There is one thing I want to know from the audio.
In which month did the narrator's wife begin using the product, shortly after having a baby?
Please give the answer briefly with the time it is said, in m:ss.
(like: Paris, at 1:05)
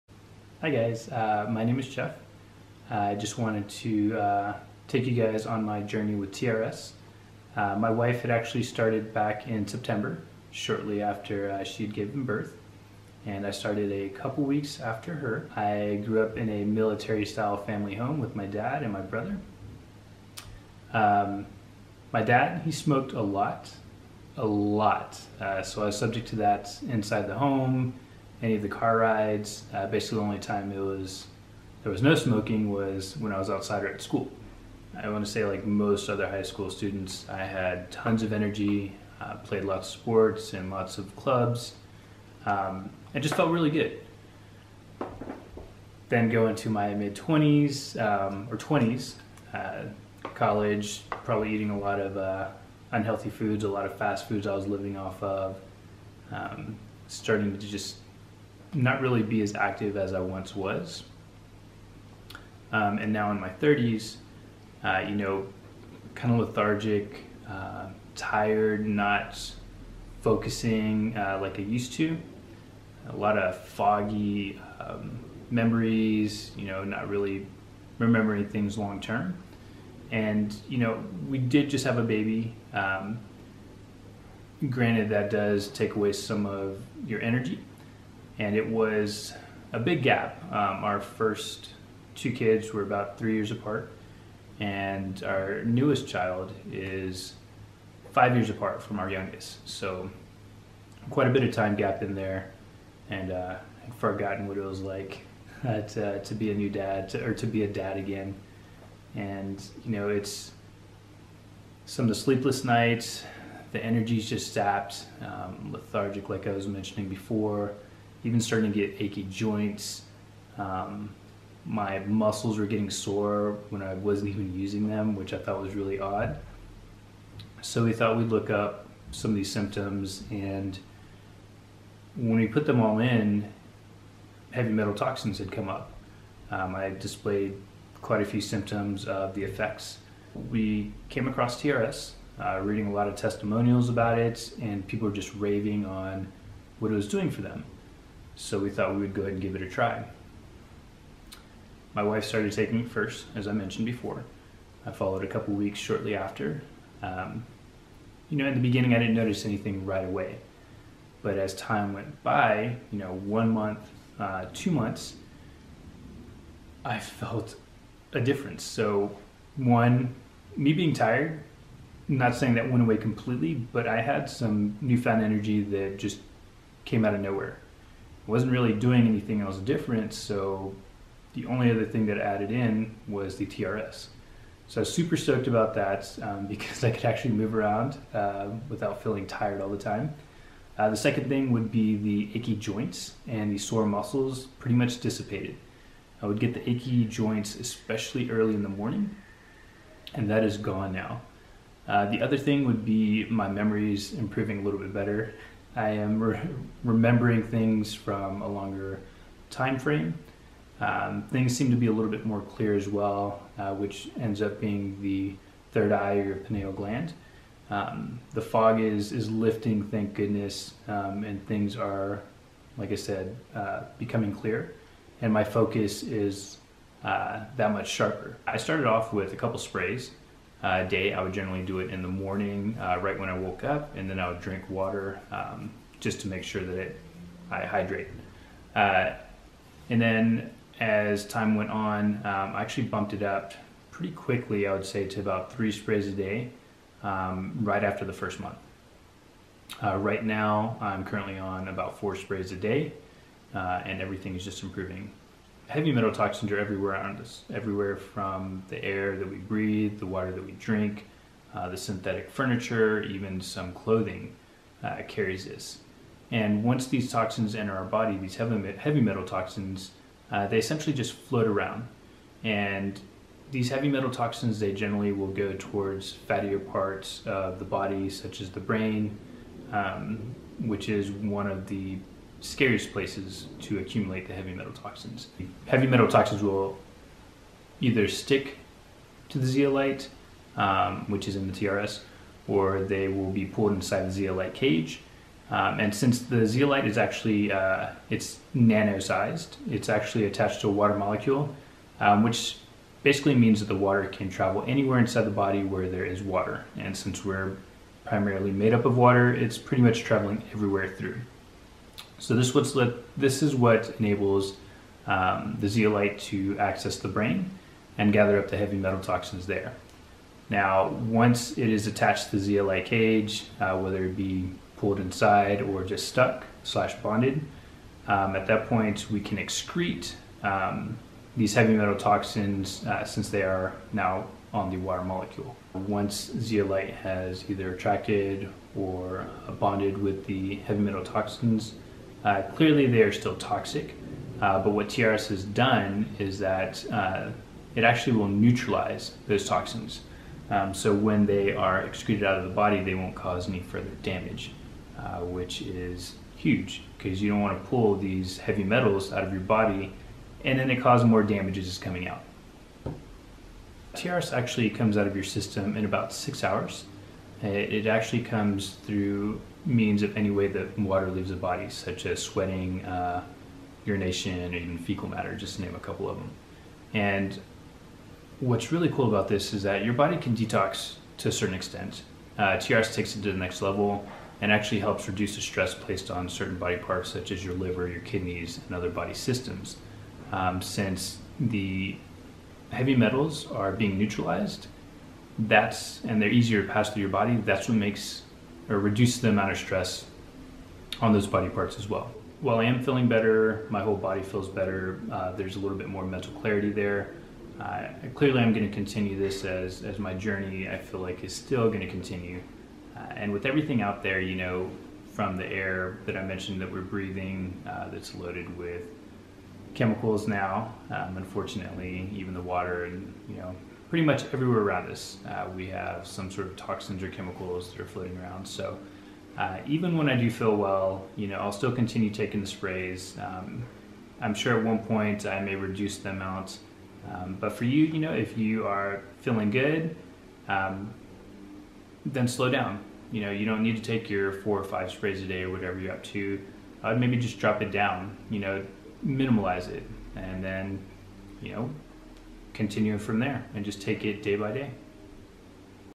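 September, at 0:09.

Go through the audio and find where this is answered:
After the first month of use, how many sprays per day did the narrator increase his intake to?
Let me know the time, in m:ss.
4:05.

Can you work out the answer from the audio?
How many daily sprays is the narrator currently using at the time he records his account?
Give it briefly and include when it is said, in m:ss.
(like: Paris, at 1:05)
4 sprays, at 4:11.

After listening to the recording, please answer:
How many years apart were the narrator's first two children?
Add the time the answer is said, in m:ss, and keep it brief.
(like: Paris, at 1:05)
3 years, at 1:33.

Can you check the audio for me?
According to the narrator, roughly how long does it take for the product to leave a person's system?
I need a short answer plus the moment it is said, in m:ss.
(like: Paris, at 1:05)
6 hours, at 6:06.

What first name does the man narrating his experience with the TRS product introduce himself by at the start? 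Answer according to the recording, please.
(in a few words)
Jeff.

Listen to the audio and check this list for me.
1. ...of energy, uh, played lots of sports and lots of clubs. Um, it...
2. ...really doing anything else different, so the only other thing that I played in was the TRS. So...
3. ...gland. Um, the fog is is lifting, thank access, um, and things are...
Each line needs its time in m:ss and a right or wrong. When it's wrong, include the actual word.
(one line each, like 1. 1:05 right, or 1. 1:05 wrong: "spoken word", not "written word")
1. 0:38 right
2. 2:58 wrong: "added", not "played"
3. 3:36 wrong: "goodness", not "access".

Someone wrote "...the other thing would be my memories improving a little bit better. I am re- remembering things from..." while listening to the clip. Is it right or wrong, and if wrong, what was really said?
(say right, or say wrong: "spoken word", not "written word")
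right.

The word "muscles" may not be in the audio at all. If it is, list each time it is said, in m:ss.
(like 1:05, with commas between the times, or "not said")
2:01, 3:13.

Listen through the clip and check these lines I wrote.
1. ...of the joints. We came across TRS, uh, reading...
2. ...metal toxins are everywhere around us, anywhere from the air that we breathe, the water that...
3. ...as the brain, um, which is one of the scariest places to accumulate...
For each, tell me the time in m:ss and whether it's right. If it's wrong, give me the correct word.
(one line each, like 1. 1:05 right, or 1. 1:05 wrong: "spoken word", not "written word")
1. 2:19 wrong: "effects", not "joints"
2. 4:15 wrong: "everywhere", not "anywhere"
3. 4:38 right.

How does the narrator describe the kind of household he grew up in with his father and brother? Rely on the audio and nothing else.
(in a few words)
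Military-style.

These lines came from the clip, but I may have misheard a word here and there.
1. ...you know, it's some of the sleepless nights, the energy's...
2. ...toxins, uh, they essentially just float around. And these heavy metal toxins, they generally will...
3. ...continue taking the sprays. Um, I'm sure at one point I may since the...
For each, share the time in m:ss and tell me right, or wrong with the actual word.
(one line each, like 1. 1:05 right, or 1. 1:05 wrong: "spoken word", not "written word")
1. 1:49 right
2. 4:29 right
3. 7:11 wrong: "reduce", not "since".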